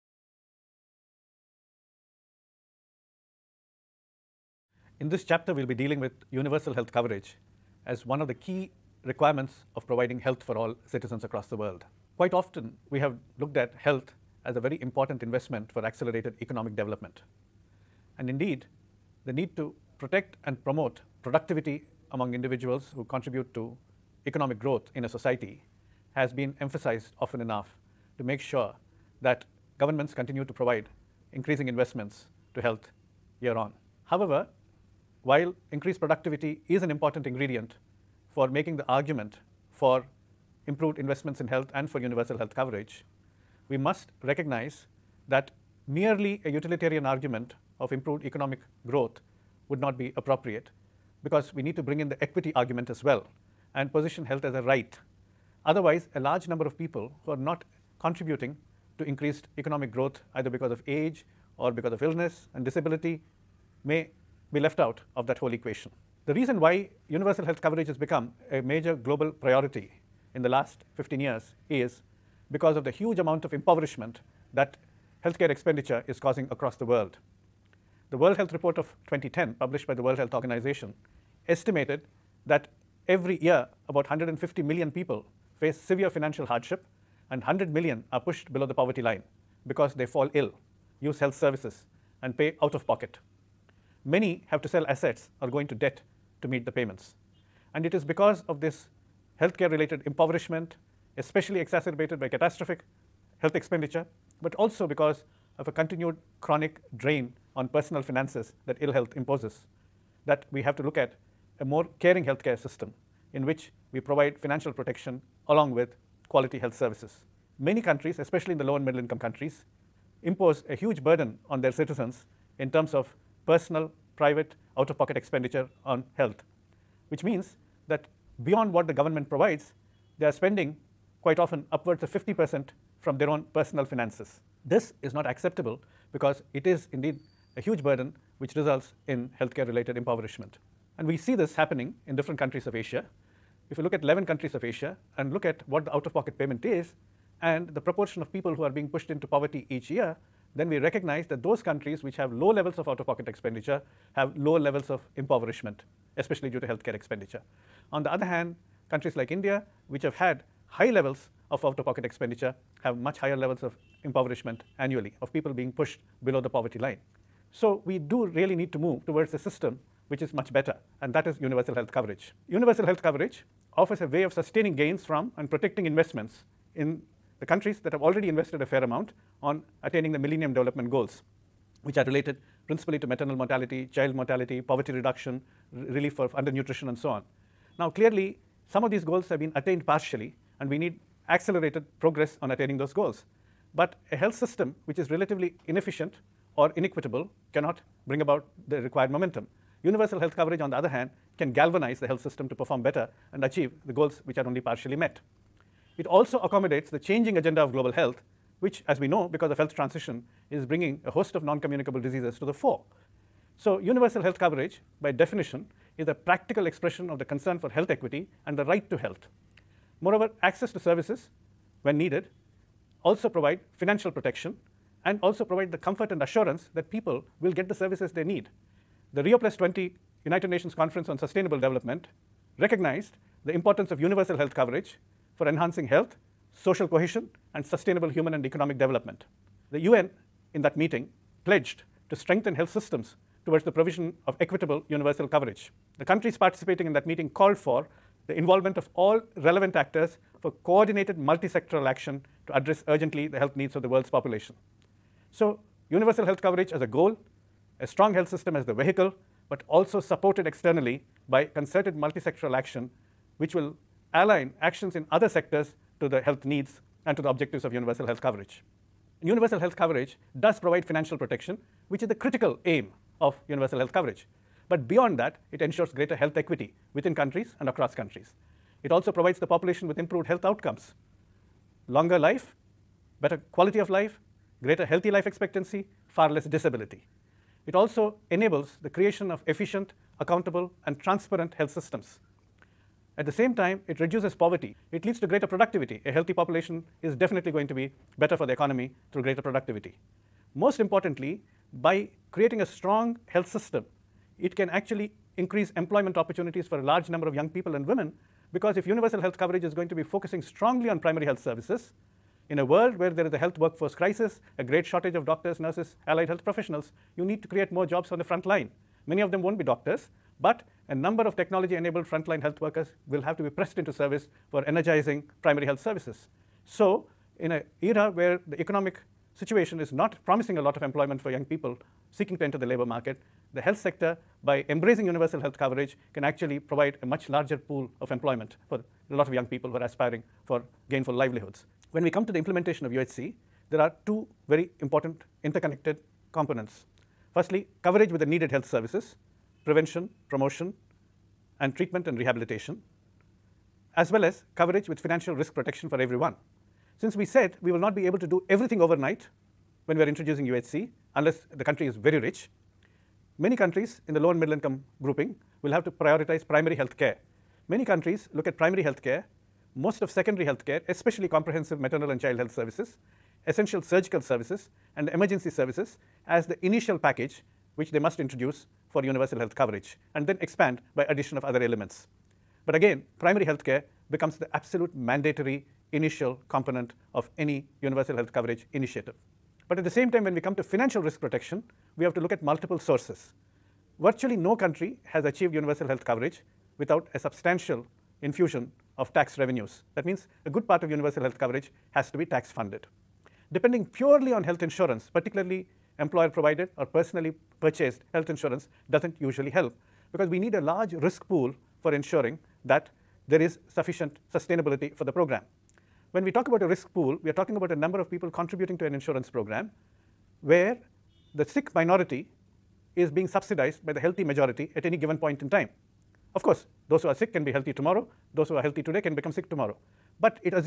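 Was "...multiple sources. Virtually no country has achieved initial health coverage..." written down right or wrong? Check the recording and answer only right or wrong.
wrong.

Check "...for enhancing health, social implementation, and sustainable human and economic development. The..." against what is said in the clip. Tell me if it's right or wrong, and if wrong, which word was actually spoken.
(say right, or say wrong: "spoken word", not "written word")
wrong: "cohesion", not "implementation".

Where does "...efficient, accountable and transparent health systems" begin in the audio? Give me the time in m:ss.
4:49.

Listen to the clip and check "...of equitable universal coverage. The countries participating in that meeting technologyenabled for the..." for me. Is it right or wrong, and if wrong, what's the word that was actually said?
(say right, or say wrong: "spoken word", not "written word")
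wrong: "called", not "technologyenabled".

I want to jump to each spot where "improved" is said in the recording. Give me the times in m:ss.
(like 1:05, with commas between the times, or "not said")
0:40, 0:47, 4:39.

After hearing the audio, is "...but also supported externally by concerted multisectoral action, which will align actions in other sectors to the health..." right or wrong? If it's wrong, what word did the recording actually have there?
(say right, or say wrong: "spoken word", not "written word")
right.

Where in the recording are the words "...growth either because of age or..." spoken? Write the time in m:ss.
0:59.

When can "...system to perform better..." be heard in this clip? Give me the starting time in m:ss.
3:22.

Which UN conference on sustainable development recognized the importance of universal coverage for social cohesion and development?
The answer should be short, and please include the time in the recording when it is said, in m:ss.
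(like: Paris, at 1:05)
Rio Plus 20, at 3:49.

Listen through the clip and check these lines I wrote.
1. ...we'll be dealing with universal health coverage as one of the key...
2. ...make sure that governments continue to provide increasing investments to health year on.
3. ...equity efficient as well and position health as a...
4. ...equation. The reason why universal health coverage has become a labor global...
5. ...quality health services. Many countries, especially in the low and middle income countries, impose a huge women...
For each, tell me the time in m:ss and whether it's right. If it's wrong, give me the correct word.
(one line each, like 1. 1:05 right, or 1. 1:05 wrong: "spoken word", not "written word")
1. 0:05 right
2. 0:28 right
3. 0:52 wrong: "argument", not "efficient"
4. 1:05 wrong: "major", not "labor"
5. 1:56 wrong: "burden", not "women".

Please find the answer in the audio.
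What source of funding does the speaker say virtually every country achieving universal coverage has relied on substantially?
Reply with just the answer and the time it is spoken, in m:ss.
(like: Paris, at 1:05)
tax revenues, at 6:39.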